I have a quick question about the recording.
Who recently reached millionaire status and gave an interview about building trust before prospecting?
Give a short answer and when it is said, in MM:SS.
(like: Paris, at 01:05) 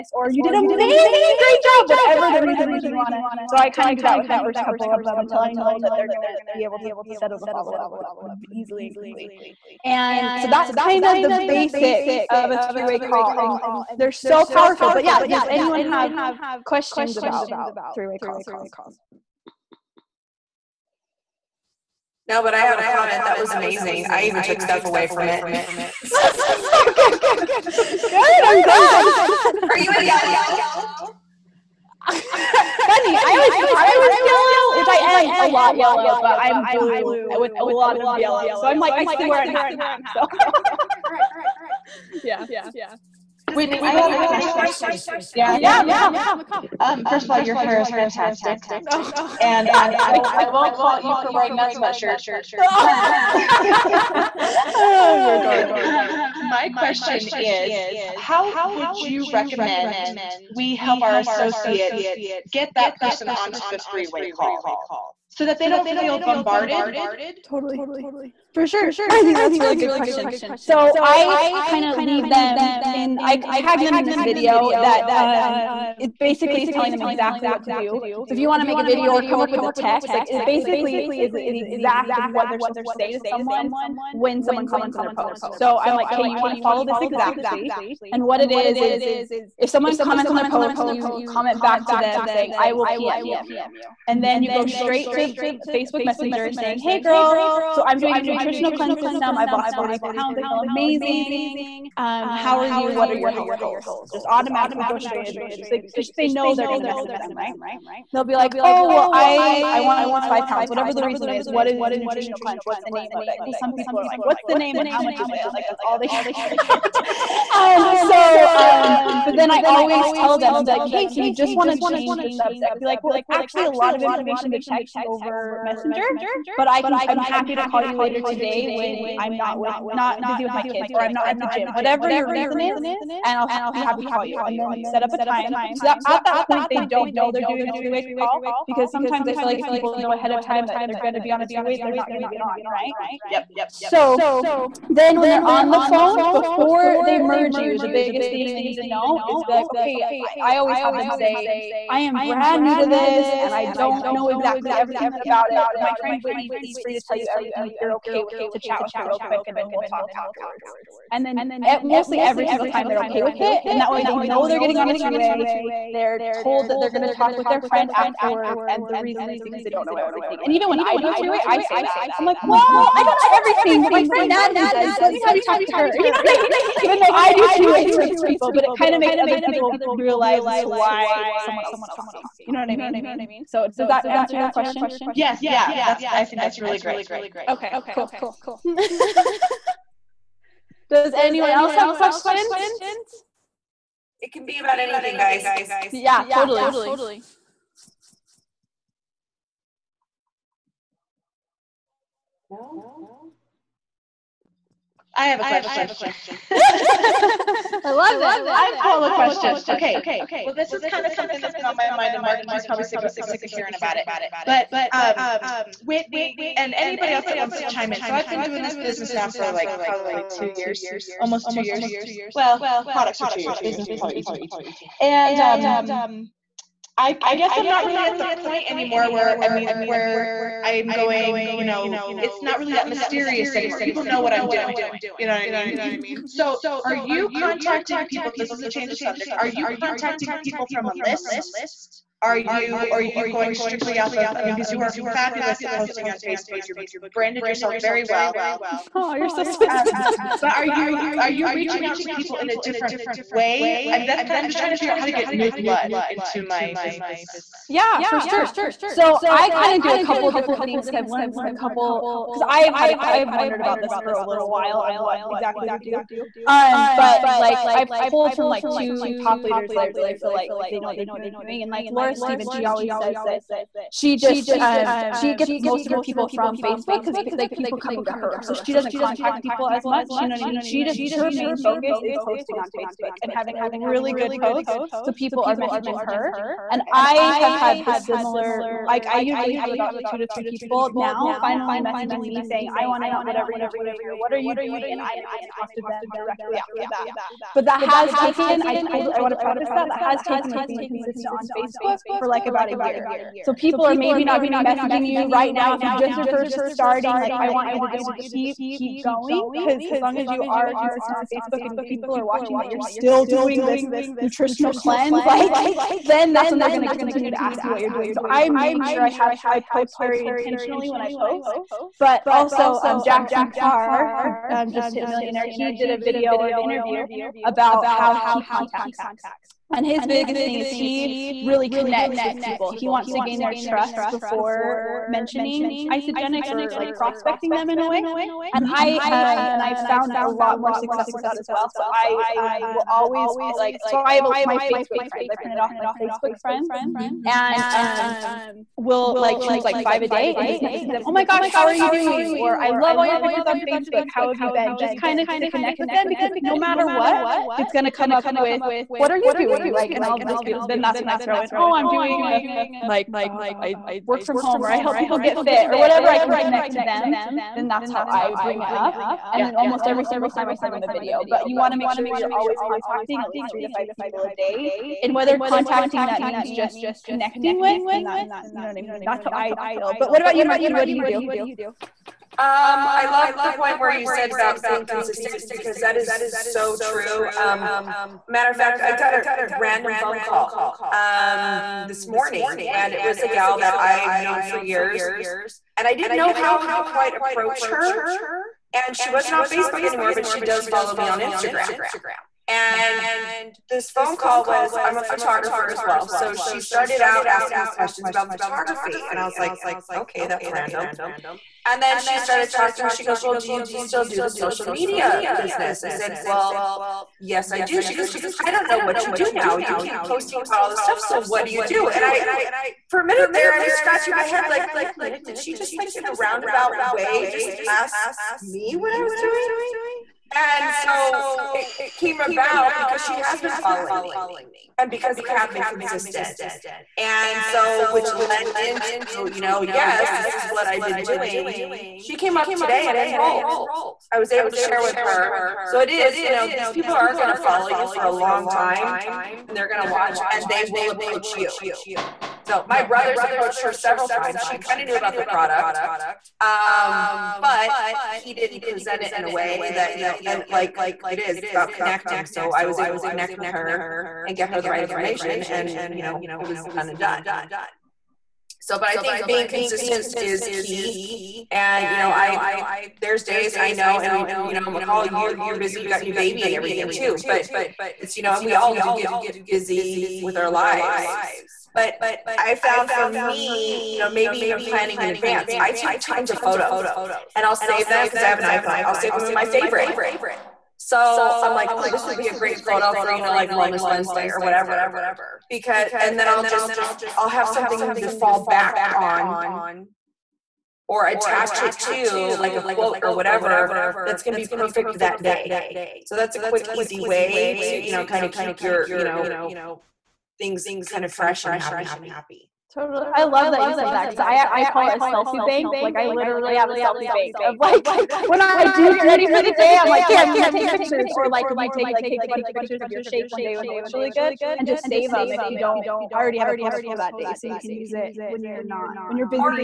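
Jackson Parr, at 05:23.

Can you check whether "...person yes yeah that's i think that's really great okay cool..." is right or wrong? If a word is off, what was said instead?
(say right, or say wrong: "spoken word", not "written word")
wrong: "question", not "person".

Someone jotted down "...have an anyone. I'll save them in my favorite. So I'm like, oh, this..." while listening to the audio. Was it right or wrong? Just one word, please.
wrong.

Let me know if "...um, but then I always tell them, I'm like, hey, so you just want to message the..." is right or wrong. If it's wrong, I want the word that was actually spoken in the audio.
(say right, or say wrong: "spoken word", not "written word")
wrong: "change", not "message".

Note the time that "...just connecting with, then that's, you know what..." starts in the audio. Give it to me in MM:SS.
06:16.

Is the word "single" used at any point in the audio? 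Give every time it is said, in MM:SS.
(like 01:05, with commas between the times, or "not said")
02:42, 06:10.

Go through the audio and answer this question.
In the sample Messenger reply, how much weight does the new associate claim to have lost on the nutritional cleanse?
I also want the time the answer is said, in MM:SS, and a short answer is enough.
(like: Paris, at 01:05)
40 pounds, at 01:39.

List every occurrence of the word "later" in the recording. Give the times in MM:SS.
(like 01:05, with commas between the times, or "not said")
02:07.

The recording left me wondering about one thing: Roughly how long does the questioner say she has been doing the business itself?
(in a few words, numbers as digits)
18 months.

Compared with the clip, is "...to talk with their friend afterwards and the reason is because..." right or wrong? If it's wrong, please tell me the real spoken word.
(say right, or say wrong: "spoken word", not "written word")
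right.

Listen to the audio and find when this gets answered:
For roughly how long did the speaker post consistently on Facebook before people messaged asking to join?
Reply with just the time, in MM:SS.
05:02.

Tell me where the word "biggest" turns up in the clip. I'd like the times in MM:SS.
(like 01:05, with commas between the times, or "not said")
02:27, 05:30.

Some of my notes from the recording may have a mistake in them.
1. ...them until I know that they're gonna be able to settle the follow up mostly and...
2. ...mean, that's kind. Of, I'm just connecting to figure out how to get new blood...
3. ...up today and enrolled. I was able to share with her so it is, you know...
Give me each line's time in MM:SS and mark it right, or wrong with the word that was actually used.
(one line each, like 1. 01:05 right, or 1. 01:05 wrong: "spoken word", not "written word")
1. 00:05 wrong: "easily", not "mostly"
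2. 04:13 wrong: "trying", not "connecting"
3. 07:22 right.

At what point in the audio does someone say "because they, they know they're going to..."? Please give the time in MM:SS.
01:45.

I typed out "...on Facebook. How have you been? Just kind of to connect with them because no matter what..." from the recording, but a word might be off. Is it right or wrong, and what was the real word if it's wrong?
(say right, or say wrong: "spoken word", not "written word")
right.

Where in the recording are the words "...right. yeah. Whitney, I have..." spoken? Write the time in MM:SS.
00:41.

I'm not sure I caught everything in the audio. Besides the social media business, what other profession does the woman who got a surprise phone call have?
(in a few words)
Photographer.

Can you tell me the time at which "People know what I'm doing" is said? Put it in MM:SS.
03:53.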